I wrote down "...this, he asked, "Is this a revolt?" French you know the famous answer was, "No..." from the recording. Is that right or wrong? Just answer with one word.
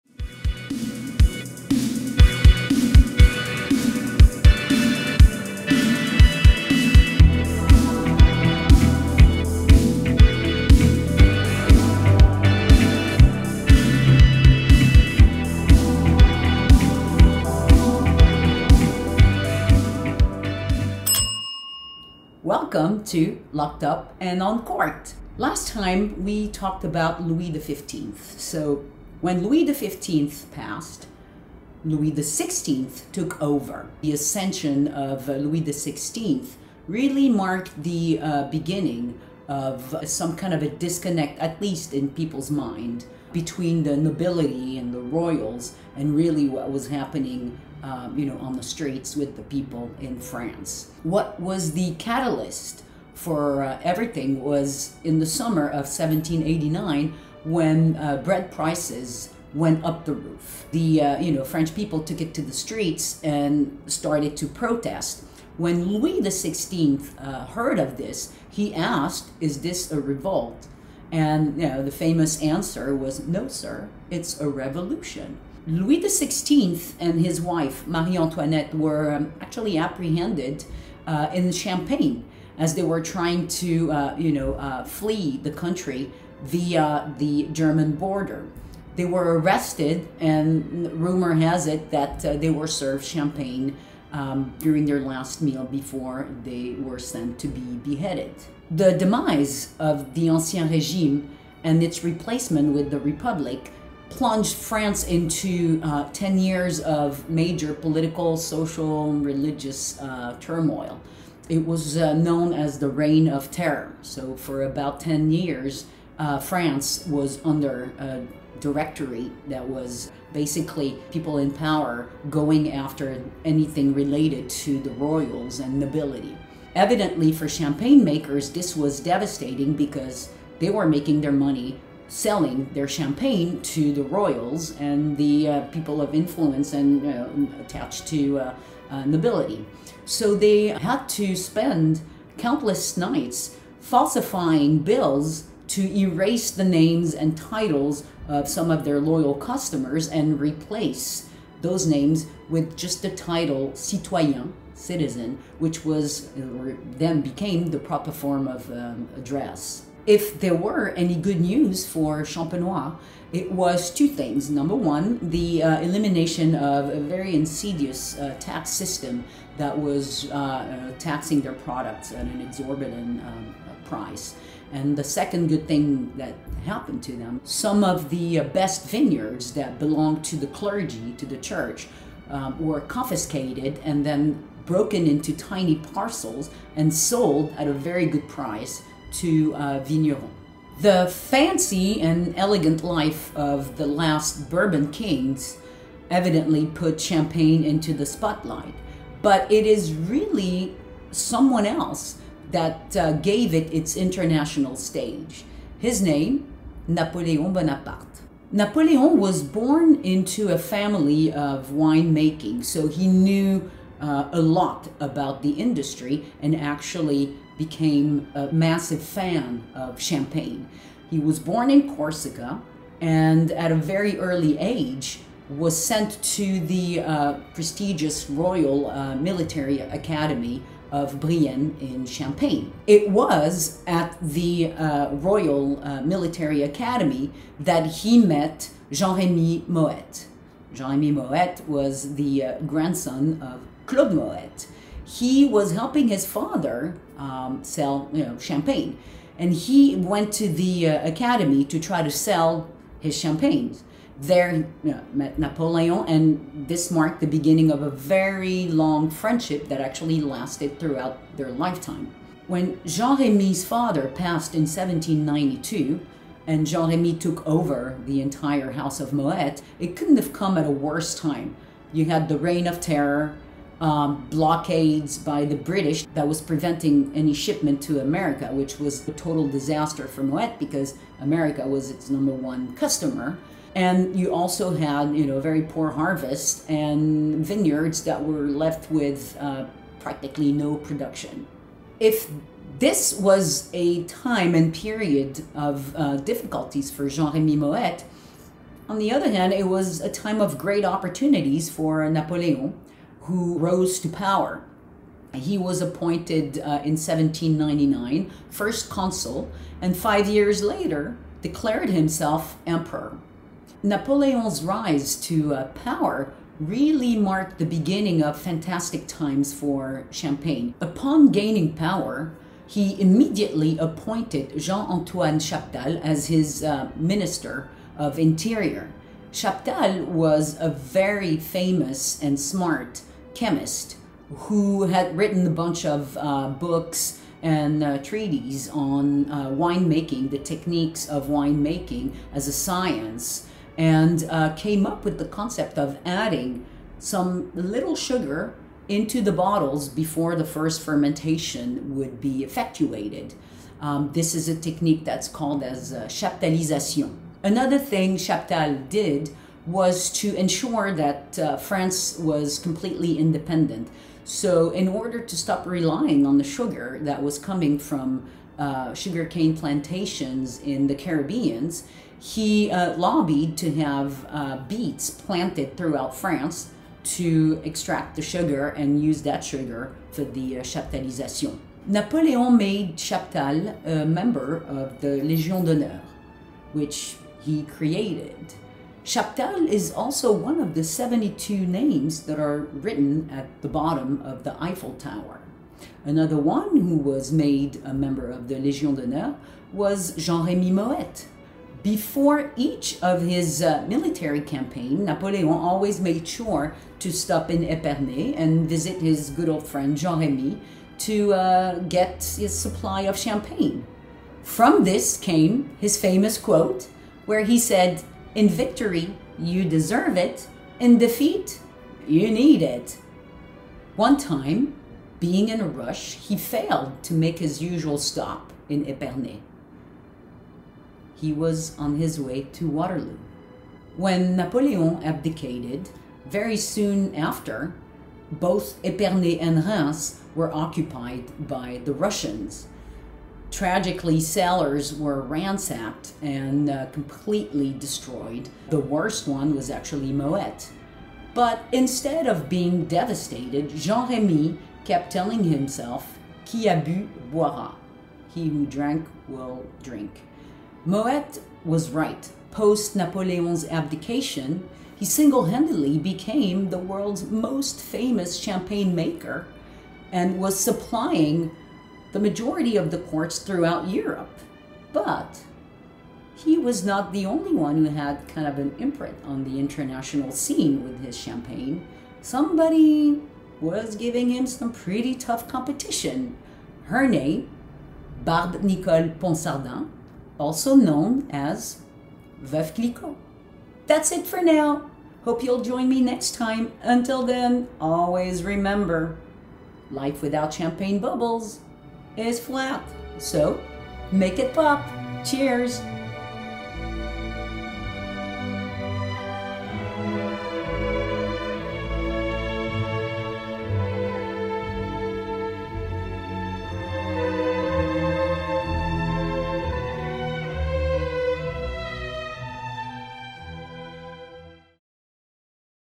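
wrong.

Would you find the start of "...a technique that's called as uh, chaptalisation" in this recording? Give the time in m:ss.
5:54.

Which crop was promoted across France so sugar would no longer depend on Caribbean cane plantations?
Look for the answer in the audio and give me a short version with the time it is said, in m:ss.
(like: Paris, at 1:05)
beets, at 6:14.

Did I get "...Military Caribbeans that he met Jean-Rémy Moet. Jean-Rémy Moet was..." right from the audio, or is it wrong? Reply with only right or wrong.
wrong.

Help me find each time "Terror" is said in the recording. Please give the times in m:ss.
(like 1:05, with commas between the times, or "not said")
1:53, 4:32.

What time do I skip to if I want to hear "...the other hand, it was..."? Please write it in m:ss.
4:58.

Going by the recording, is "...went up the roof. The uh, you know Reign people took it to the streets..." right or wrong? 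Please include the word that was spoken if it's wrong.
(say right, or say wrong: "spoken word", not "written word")
wrong: "French", not "Reign".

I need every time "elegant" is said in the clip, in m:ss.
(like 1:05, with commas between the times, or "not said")
3:12.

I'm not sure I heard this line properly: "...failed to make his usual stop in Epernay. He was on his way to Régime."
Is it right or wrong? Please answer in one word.
wrong.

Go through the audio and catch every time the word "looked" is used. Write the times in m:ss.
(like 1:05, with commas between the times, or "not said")
not said.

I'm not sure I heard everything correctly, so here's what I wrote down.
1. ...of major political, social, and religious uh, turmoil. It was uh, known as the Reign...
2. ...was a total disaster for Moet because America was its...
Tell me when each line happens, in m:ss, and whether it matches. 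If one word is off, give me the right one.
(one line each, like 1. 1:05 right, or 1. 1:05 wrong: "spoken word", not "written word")
1. 1:46 right
2. 4:38 right.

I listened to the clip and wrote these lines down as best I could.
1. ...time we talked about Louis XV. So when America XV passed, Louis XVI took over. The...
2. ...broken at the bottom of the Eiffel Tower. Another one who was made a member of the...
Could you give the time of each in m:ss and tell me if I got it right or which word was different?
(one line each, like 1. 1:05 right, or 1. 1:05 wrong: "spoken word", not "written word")
1. 0:25 wrong: "Louis", not "America"
2. 6:32 wrong: "written", not "broken".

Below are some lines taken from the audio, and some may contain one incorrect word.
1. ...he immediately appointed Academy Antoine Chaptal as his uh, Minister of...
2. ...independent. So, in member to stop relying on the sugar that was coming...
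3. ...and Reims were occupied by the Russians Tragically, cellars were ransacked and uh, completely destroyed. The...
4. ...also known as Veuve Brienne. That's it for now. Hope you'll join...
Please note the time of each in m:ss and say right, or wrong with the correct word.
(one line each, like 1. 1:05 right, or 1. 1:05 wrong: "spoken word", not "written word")
1. 5:22 wrong: "Jean", not "Academy"
2. 6:03 wrong: "order", not "member"
3. 7:19 right
4. 8:10 wrong: "Clicquot", not "Brienne".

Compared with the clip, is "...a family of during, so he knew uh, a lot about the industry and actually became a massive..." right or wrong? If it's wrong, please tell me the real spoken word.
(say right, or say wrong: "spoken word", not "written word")
wrong: "winemaking", not "during".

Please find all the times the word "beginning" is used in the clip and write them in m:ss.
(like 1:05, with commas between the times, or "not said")
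0:38, 4:17, 5:17.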